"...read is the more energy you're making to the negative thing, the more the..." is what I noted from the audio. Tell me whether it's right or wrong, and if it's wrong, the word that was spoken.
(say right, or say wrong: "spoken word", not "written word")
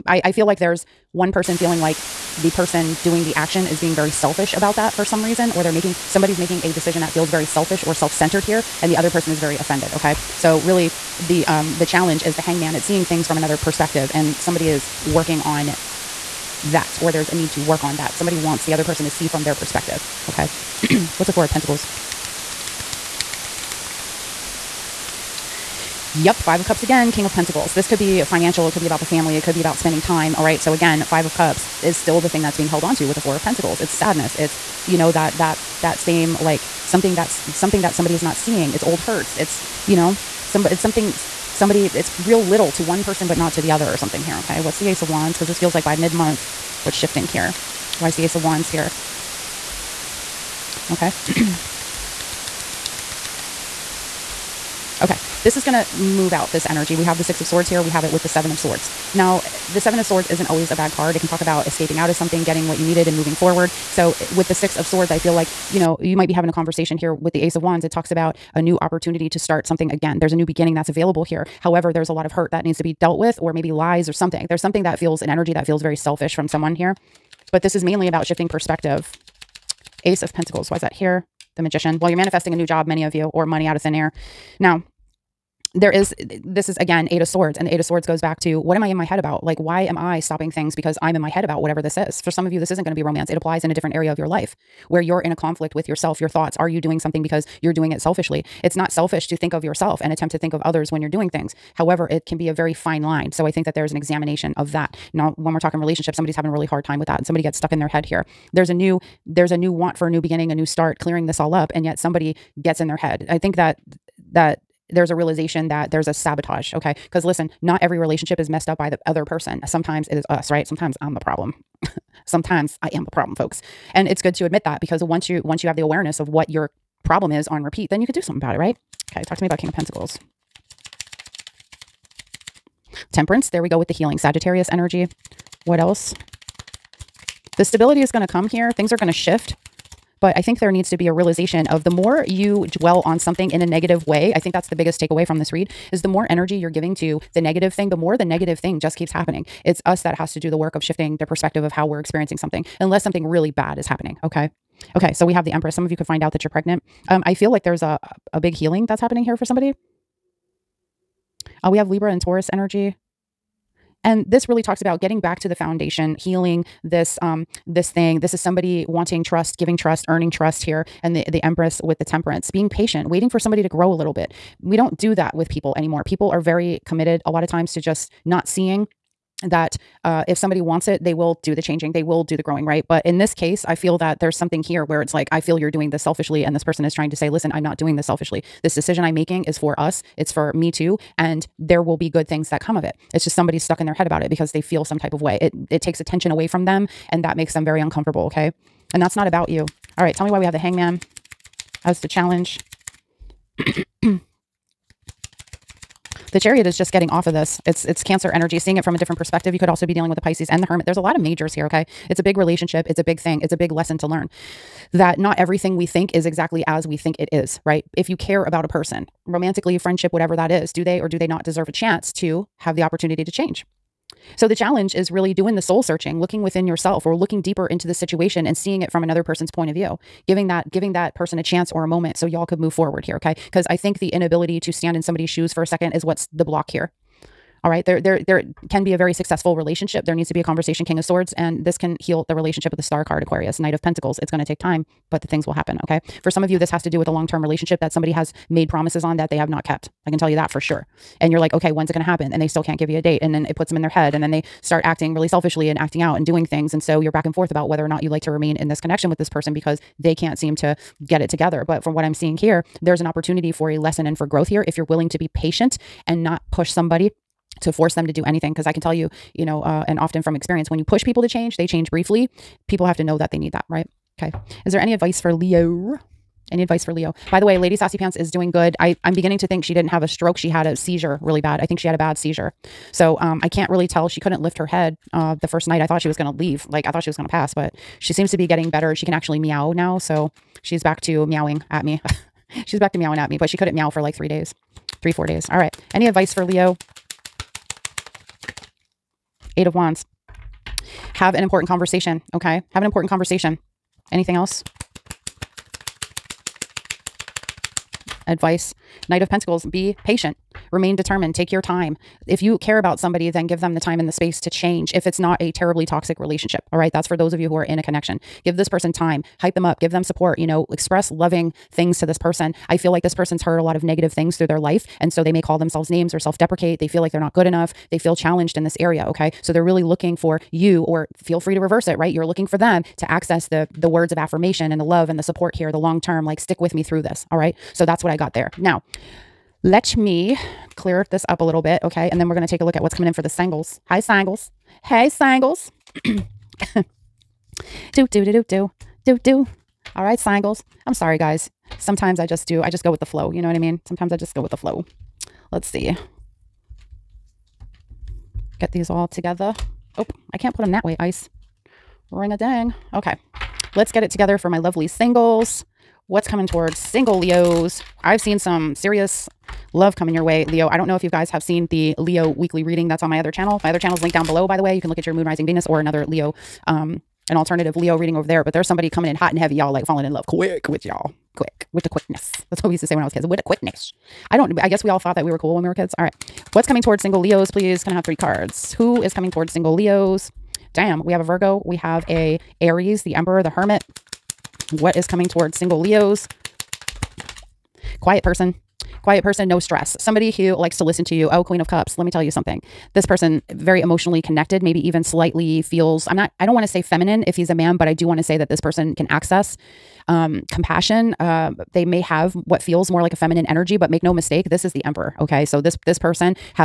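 wrong: "giving", not "making".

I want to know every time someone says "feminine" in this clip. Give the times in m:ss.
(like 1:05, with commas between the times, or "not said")
6:46, 6:53.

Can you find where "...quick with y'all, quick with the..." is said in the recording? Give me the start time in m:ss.
6:20.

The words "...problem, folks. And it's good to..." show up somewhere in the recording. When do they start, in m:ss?
2:03.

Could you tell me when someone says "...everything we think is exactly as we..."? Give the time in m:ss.
3:35.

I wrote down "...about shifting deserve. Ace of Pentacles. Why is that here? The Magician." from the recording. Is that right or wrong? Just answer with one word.
wrong.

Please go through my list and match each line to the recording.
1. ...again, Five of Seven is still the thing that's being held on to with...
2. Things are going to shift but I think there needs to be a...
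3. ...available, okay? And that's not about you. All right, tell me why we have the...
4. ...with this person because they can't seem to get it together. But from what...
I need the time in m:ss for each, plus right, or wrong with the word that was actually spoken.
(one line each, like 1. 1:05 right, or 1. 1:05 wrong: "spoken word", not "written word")
1. 0:30 wrong: "Cups", not "Seven"
2. 2:18 right
3. 3:17 wrong: "uncomfortable", not "available"
4. 4:19 right.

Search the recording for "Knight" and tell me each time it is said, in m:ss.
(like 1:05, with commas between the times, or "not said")
4:03, 5:09.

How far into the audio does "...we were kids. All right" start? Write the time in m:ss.
6:25.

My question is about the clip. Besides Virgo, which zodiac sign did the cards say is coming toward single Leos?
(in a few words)
Aries.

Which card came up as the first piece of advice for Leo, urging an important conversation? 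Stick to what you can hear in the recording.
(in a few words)
Eight of Wands.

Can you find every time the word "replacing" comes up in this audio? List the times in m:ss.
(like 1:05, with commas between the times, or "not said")
not said.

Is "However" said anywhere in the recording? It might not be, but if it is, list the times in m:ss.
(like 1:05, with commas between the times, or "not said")
1:11, 1:41.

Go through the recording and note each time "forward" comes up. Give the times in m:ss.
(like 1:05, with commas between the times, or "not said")
1:03, 3:52.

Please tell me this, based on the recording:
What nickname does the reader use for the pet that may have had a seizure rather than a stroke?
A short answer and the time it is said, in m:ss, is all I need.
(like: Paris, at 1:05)
Lady Saucy Pants, at 4:37.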